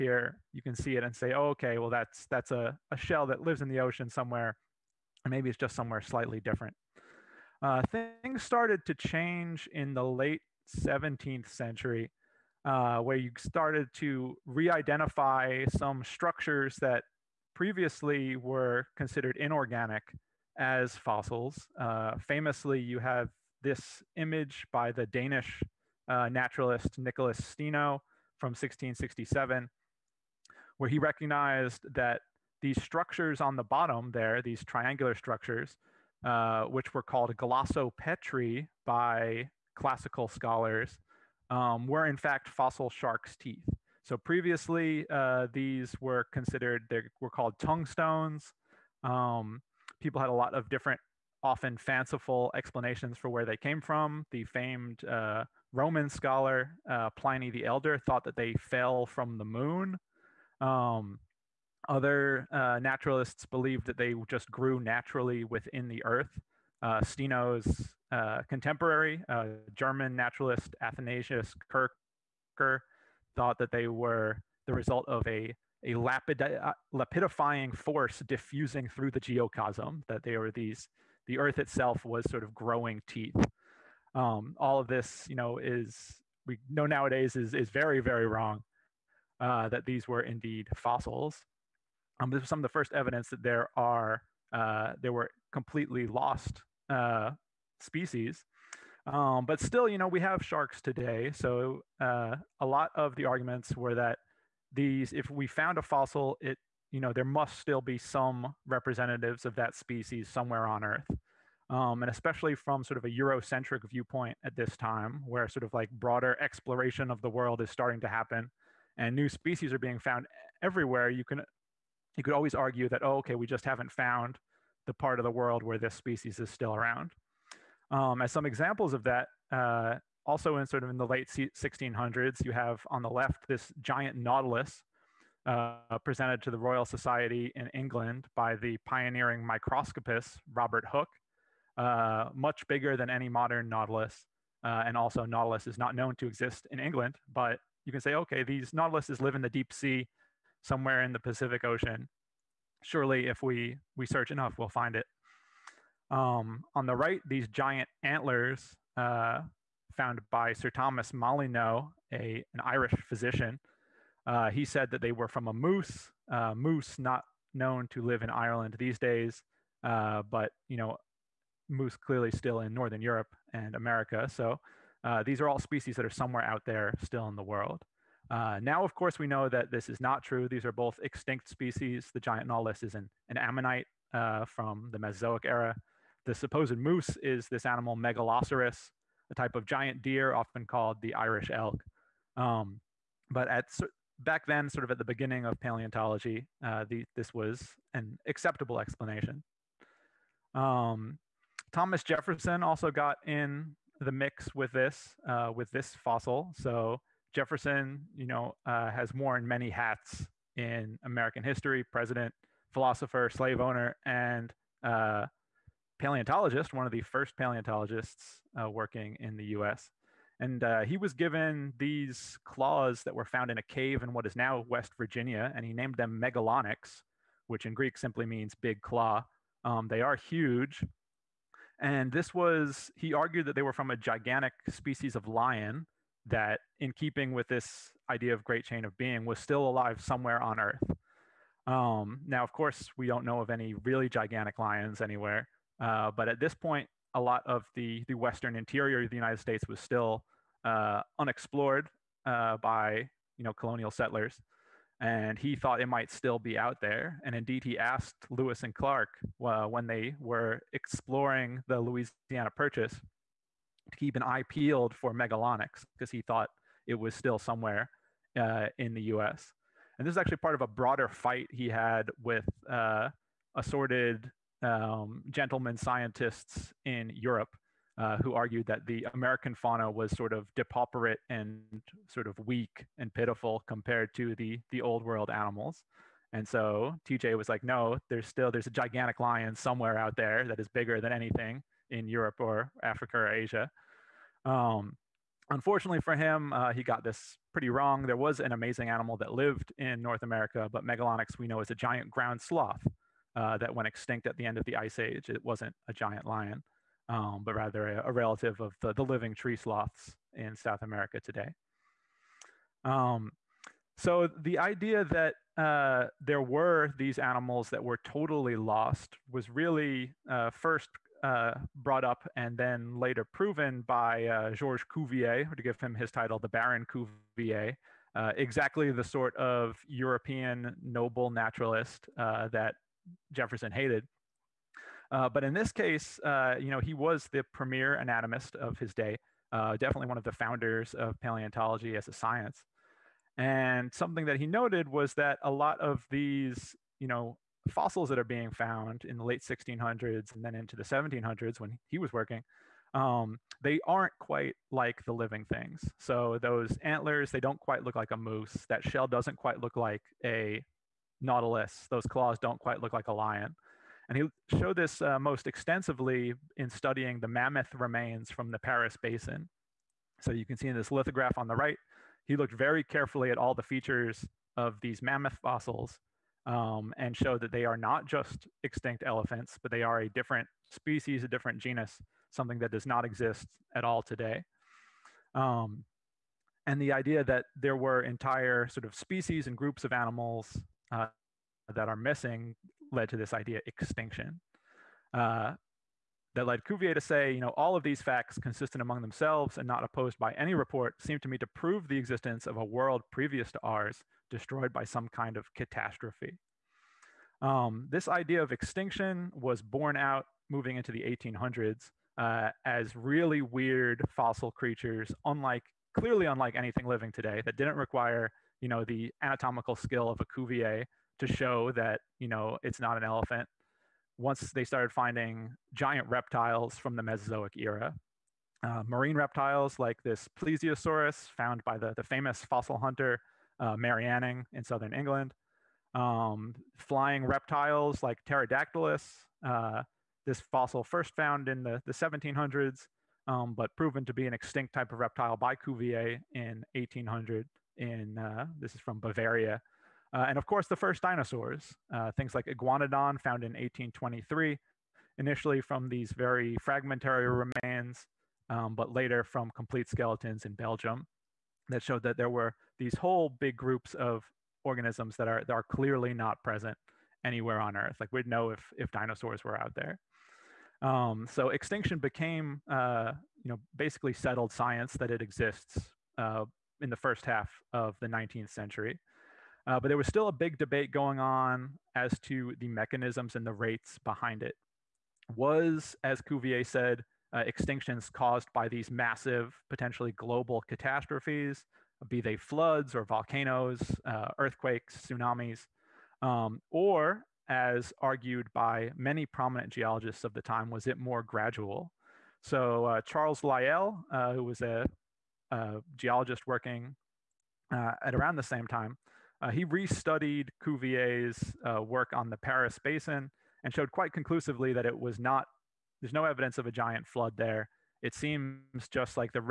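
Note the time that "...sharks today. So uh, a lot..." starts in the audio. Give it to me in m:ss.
1:40.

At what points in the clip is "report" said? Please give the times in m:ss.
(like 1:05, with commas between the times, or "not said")
6:40.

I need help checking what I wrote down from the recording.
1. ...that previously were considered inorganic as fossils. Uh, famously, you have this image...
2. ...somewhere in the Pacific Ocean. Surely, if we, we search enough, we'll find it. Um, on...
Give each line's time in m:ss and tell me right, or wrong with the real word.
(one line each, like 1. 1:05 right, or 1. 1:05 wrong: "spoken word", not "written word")
1. 0:16 right
2. 2:30 right.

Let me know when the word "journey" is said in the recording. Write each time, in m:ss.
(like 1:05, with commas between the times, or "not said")
not said.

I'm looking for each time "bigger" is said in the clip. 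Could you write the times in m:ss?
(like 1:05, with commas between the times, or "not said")
2:22, 4:50.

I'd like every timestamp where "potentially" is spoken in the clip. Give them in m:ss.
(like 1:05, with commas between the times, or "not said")
8:09.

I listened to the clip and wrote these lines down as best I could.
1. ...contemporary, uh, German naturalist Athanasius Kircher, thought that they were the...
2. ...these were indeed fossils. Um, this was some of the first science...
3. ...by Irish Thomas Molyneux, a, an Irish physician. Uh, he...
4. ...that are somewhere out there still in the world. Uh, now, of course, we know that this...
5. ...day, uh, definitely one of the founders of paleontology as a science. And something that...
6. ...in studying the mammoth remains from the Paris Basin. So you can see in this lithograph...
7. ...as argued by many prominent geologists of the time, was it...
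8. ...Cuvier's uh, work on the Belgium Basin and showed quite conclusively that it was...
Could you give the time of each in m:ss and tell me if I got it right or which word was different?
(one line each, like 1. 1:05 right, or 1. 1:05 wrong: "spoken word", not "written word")
1. 1:08 right
2. 1:29 wrong: "evidence", not "science"
3. 2:40 wrong: "Sir", not "Irish"
4. 2:55 right
5. 5:38 right
6. 6:06 right
7. 8:17 right
8. 8:30 wrong: "Paris", not "Belgium".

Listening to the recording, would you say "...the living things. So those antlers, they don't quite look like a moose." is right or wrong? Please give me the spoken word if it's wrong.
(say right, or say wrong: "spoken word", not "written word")
right.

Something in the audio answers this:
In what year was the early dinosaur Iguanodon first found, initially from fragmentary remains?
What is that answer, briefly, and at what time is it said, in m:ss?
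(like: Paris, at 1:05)
1823, at 7:33.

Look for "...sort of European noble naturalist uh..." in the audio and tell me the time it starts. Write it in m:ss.
5:29.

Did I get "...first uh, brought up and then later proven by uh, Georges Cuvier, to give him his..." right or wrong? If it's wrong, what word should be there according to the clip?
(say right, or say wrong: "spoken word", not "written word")
right.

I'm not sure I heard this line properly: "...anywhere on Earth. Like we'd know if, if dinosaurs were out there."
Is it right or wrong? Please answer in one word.
right.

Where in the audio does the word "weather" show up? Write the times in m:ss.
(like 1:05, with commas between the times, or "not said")
not said.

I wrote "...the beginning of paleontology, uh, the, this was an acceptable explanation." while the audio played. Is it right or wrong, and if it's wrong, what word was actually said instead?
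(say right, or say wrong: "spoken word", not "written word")
right.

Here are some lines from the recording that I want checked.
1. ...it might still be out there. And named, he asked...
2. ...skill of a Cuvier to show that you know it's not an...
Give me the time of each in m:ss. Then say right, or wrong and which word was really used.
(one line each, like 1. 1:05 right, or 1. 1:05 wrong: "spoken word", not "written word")
1. 4:15 wrong: "indeed", not "named"
2. 6:59 right.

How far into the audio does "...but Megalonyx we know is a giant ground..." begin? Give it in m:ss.
5:00.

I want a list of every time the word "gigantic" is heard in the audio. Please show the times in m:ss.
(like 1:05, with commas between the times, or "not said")
3:53, 4:04, 4:48.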